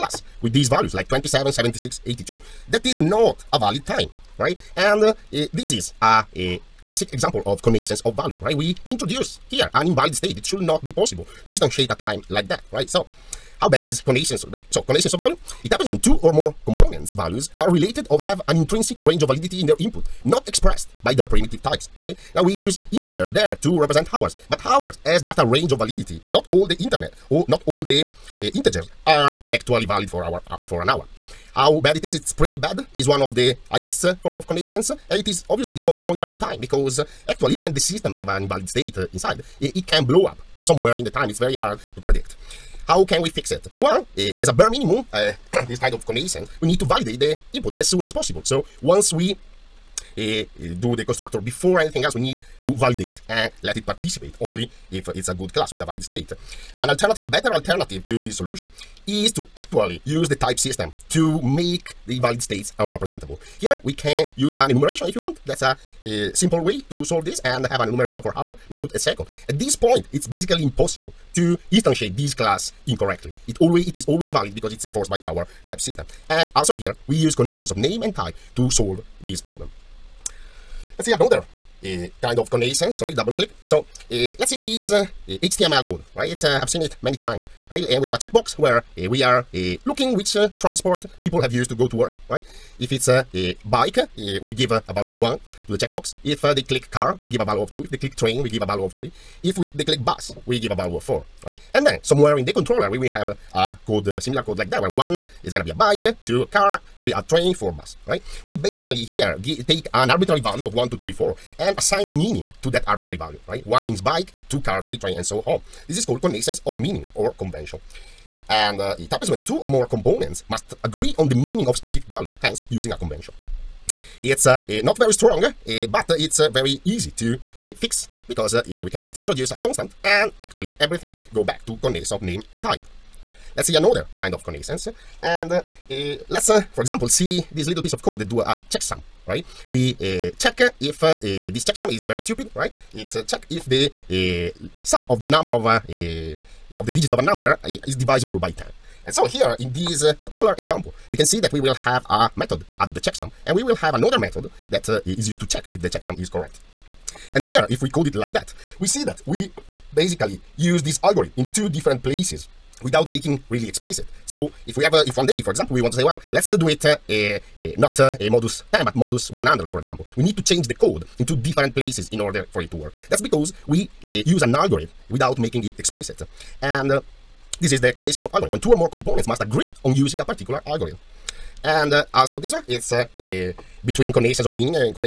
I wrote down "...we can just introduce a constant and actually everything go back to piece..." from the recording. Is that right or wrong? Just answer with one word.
wrong.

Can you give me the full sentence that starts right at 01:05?
That's a, a uh, simple way to solve this and have an enumeration for hour, minute, a second.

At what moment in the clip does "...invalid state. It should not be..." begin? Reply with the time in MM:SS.
00:09.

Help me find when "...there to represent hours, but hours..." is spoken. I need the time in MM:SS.
00:23.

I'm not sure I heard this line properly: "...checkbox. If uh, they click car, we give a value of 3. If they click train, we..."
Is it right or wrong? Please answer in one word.
wrong.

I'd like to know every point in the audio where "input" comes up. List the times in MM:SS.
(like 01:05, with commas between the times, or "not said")
00:19, 00:47.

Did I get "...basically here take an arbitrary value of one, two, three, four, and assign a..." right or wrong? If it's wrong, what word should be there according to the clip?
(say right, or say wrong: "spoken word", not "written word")
right.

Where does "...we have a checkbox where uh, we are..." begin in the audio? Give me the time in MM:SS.
01:28.